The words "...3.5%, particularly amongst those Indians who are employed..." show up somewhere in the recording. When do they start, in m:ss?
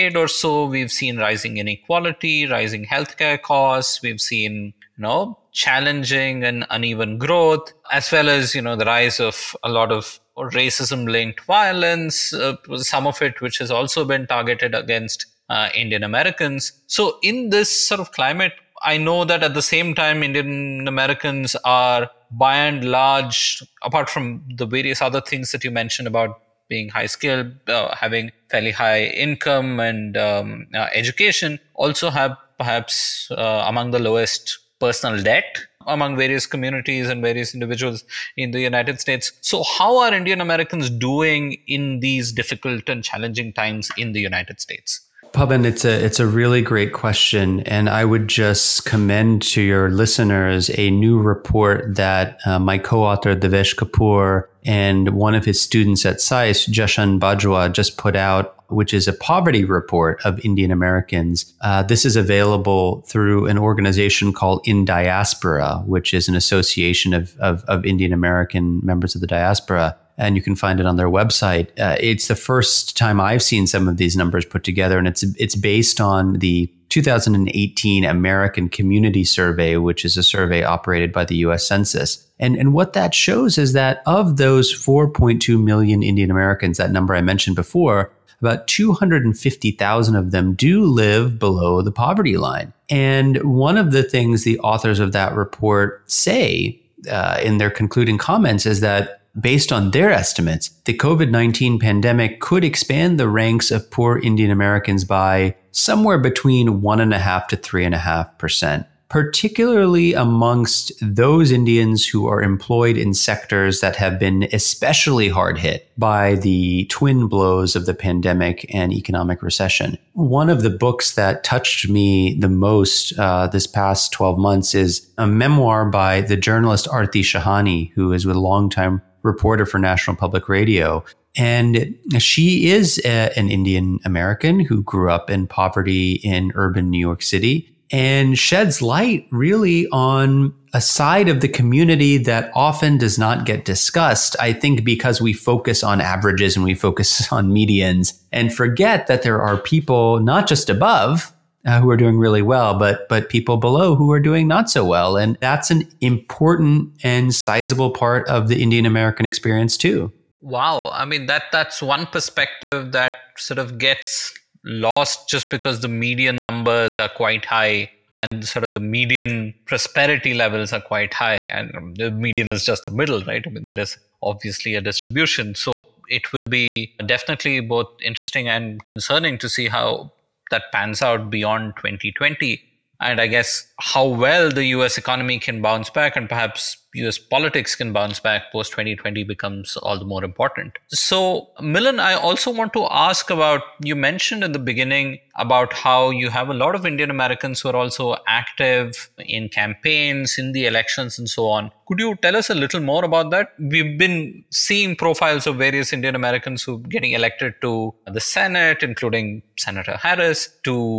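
1:47.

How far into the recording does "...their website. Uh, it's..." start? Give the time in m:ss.
1:10.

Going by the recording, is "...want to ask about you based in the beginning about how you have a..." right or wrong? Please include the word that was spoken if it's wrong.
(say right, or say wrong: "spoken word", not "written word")
wrong: "mentioned", not "based".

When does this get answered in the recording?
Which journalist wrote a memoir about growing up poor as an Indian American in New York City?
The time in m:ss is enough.
2:06.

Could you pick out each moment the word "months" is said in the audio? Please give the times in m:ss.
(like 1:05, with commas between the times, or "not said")
2:04.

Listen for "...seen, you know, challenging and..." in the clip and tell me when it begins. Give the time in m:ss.
0:04.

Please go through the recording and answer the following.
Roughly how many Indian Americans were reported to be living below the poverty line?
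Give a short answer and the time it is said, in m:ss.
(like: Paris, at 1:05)
250,000, at 1:28.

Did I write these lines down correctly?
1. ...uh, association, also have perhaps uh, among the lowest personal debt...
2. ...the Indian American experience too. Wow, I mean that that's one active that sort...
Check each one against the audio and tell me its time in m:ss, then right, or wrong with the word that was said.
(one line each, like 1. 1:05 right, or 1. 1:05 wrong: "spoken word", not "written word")
1. 0:30 wrong: "education", not "association"
2. 2:38 wrong: "perspective", not "active".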